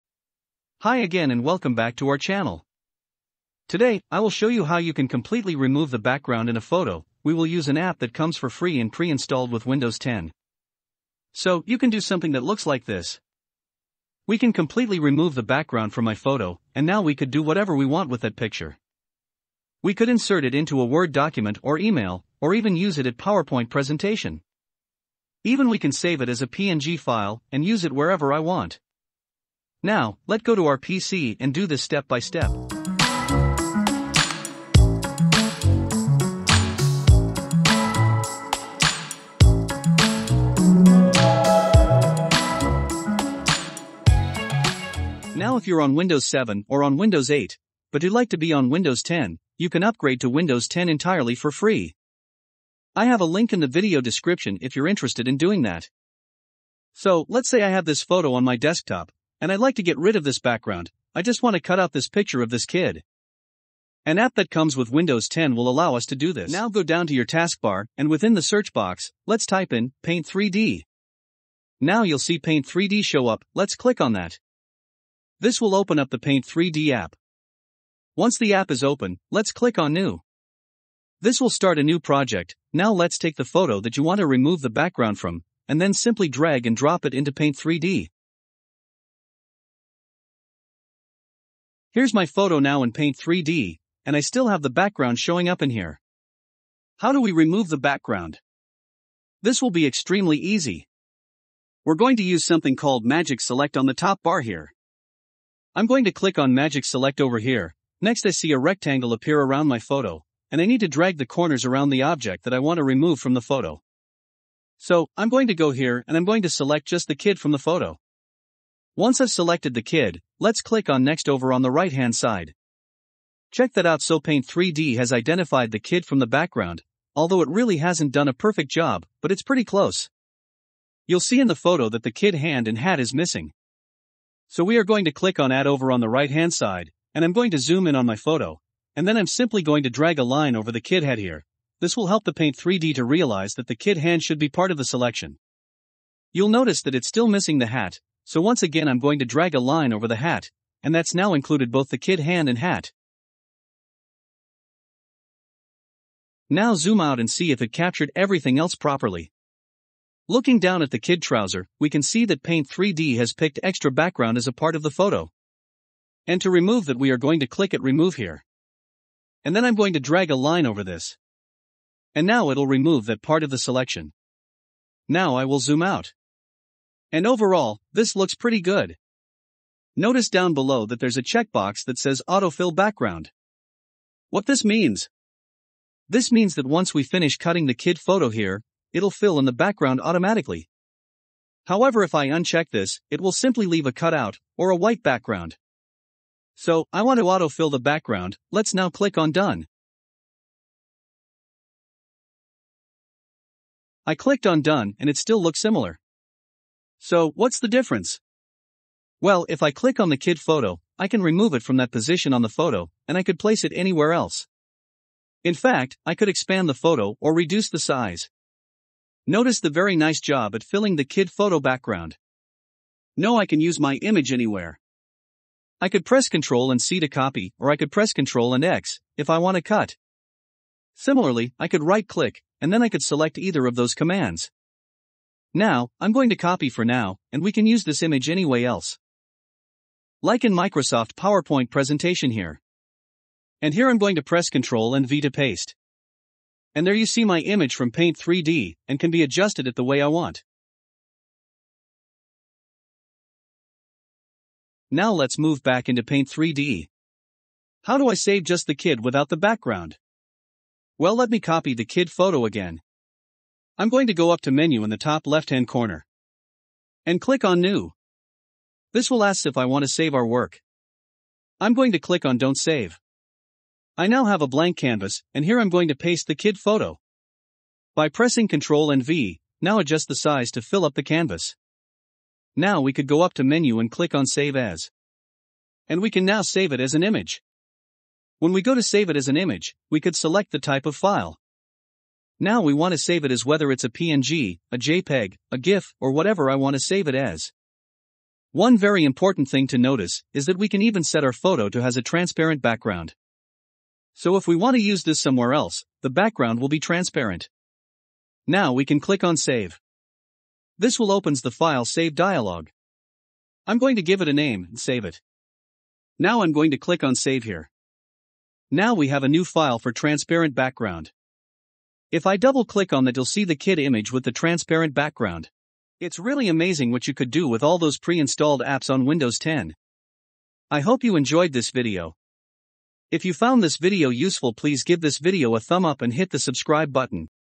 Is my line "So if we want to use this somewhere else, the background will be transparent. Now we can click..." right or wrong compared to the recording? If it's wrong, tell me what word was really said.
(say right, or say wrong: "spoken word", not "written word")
right.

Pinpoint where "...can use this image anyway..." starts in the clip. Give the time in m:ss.
3:57.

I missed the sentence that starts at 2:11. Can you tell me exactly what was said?
You'll see in the photo that the kid hand and hat is missing.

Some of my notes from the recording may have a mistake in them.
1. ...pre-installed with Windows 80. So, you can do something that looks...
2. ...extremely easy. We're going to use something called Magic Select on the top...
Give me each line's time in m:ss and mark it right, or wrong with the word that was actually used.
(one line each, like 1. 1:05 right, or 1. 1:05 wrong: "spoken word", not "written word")
1. 0:08 wrong: "10", not "80"
2. 1:39 right.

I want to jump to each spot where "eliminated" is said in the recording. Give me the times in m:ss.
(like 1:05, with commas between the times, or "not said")
not said.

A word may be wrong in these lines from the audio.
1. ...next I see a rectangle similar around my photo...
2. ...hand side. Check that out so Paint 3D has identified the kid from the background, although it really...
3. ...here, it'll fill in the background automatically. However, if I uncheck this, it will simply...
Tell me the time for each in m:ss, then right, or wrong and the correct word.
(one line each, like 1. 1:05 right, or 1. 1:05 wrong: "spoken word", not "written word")
1. 1:47 wrong: "appear", not "similar"
2. 2:01 right
3. 3:08 right.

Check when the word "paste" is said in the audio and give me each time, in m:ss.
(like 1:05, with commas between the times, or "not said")
4:05, 4:35.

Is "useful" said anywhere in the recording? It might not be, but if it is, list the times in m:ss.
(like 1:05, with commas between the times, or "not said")
5:34.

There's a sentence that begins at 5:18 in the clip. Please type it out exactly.
Now we have a new file for transparent background.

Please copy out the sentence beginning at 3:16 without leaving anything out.
So, I want to autofill the background, let's now click on Done.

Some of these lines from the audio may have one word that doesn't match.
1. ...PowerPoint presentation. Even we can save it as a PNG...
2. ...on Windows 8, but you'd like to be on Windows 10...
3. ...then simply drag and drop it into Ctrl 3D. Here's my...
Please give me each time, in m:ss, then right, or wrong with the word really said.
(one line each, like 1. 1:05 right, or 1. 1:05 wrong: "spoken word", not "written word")
1. 0:23 right
2. 0:46 right
3. 1:25 wrong: "Paint", not "Ctrl".